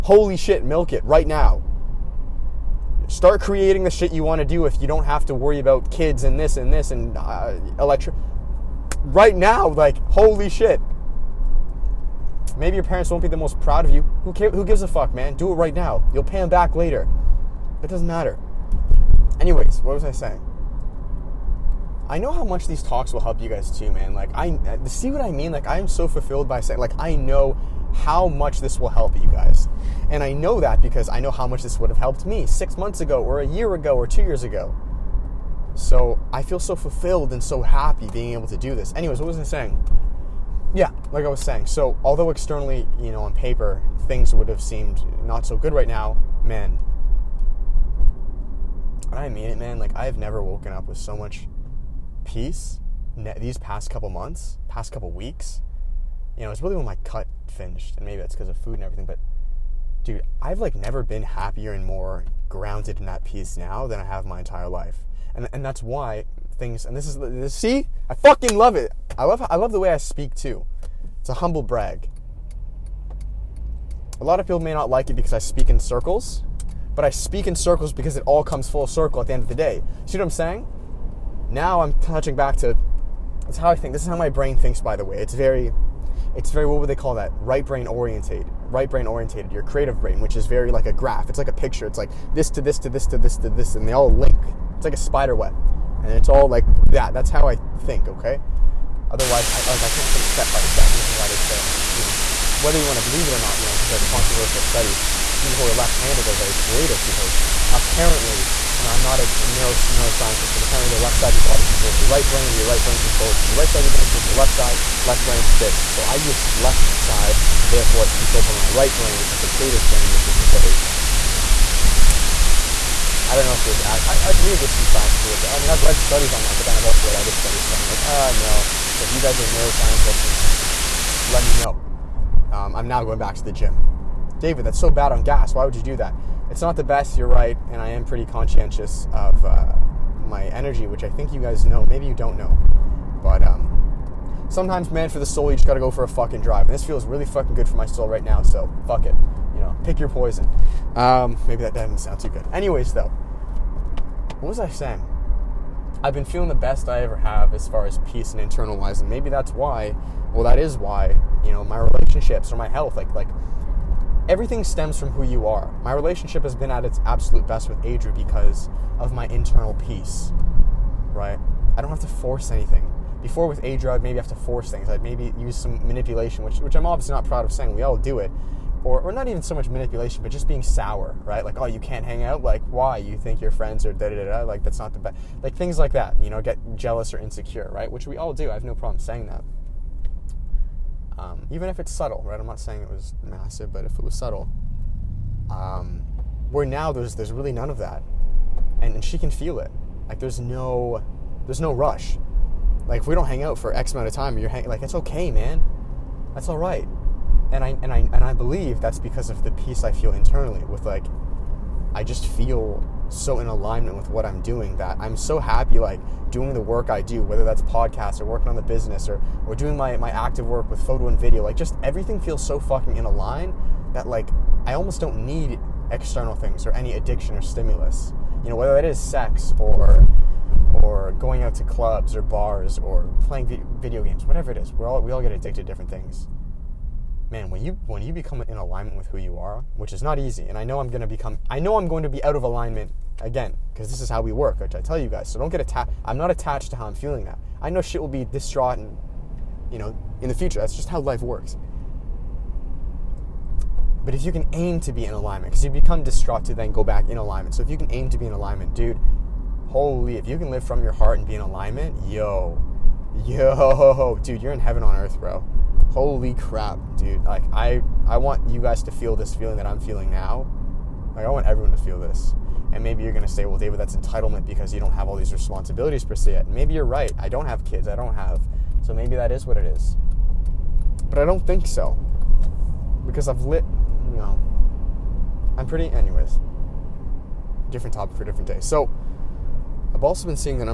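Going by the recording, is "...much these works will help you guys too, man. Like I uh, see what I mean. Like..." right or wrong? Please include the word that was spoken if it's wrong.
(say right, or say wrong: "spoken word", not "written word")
wrong: "talks", not "works".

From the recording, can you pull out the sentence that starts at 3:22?
Like if we don't hang out for X amount of time, you're hang- like it's okay, man.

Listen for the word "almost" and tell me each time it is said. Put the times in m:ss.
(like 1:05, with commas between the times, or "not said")
3:44.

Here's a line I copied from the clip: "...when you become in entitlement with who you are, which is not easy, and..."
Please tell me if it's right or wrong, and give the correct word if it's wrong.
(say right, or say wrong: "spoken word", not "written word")
wrong: "alignment", not "entitlement".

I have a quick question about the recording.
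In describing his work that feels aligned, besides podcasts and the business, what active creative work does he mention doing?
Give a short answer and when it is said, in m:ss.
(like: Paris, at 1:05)
Photo and video, at 3:40.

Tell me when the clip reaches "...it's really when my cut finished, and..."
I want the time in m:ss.
0:56.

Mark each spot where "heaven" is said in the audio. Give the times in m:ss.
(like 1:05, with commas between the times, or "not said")
4:24.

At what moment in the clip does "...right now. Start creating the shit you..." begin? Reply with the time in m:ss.
0:01.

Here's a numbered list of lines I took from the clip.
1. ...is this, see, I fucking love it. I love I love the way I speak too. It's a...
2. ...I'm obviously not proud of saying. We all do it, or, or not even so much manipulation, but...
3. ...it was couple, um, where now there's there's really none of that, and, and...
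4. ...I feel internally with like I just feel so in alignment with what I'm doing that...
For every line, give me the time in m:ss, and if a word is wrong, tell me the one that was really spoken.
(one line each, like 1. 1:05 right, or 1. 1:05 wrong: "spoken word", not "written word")
1. 1:07 right
2. 2:56 right
3. 3:13 wrong: "subtle", not "couple"
4. 3:29 right.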